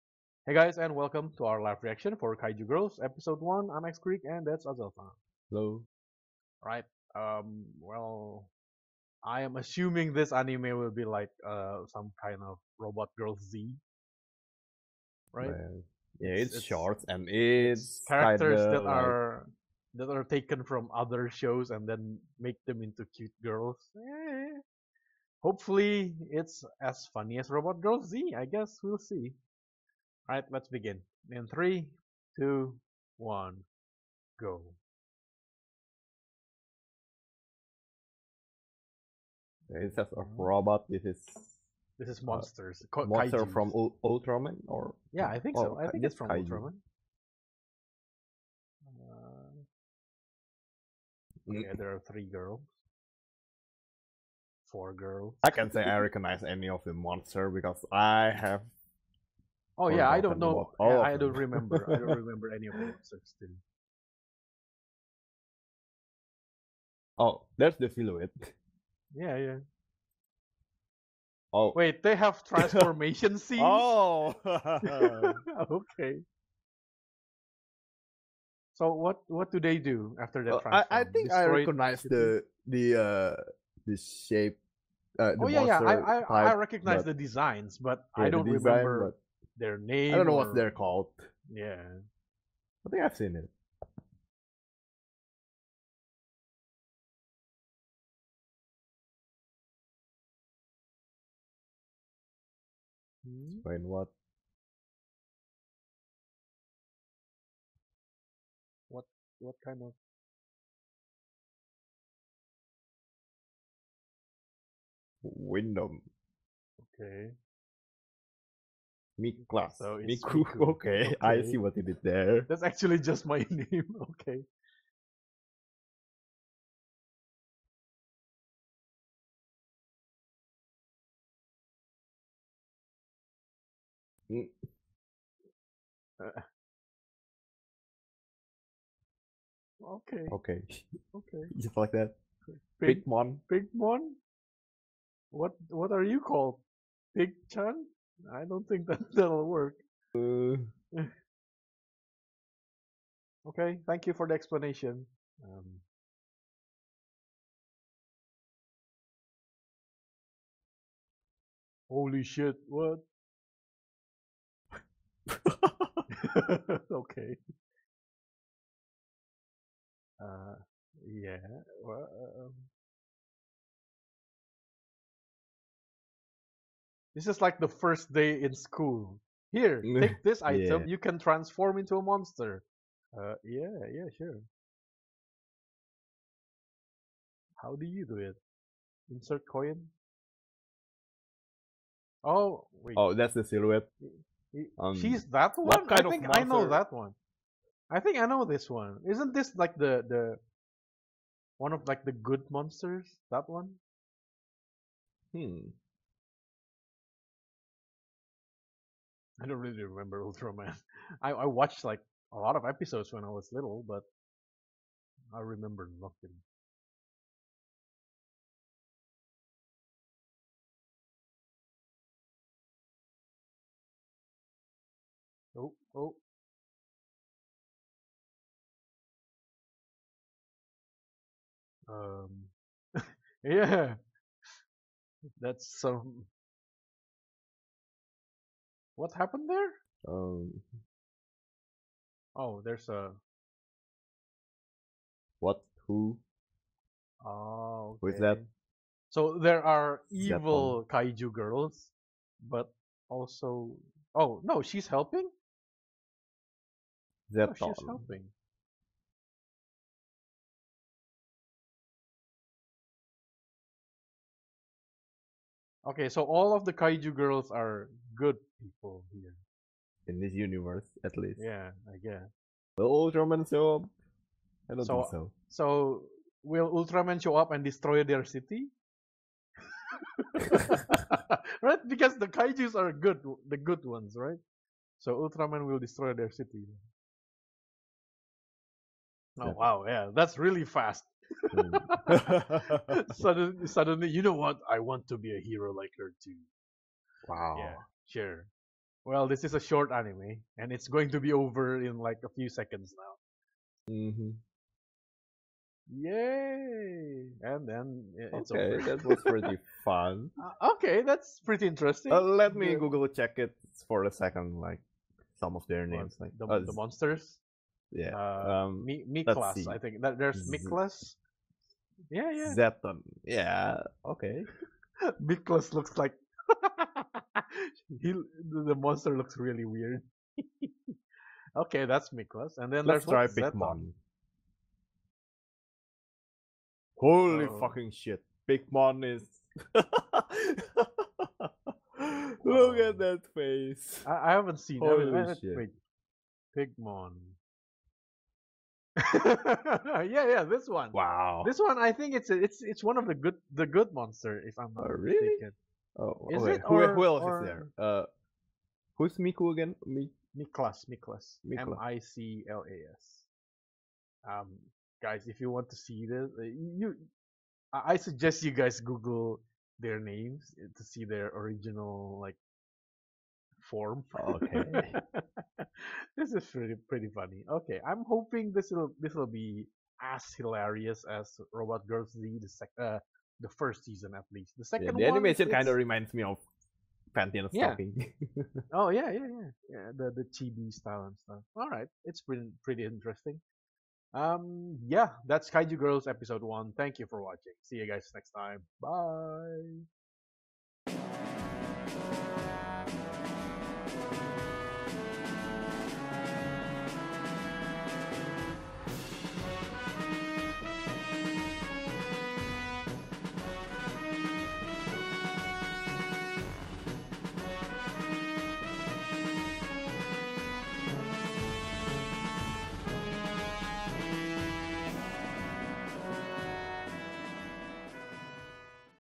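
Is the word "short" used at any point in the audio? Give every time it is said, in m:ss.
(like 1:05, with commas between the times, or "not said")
0:16, 4:59.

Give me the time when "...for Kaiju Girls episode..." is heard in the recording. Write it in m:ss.
0:02.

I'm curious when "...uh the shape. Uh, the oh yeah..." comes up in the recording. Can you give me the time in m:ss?
1:22.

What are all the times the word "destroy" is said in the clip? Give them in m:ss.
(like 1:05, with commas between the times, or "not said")
4:37, 4:45.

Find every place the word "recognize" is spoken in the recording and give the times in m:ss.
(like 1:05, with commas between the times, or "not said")
0:55, 1:21, 1:26.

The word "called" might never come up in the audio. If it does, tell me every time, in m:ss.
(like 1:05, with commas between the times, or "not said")
1:30, 2:26.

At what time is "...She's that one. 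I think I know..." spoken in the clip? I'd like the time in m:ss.
3:14.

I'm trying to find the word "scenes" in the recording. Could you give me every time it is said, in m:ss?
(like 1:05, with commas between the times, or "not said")
1:13.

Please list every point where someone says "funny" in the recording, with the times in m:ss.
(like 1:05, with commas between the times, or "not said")
0:27, 6:17.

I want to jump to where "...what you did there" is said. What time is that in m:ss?
2:01.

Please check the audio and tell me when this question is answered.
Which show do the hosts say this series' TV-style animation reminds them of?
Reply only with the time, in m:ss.
6:27.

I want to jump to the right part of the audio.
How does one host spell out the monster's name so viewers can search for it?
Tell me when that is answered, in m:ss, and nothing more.
6:01.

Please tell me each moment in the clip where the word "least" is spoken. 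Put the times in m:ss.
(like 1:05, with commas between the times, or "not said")
4:31, 6:24.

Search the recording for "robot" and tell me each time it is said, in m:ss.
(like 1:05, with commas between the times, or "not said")
0:12, 0:27, 0:40, 6:21.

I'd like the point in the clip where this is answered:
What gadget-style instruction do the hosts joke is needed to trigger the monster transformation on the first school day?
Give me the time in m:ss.
3:09.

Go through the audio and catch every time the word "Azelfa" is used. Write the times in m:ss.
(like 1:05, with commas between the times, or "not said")
0:04.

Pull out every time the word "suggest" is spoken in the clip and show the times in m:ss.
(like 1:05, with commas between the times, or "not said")
6:07.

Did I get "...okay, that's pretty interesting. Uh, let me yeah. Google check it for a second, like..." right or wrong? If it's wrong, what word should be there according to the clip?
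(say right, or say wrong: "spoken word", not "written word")
right.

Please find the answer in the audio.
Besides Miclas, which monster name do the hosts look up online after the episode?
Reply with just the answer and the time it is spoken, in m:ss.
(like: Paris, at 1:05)
Zetton, at 5:22.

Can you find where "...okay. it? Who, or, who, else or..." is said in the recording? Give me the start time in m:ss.
5:56.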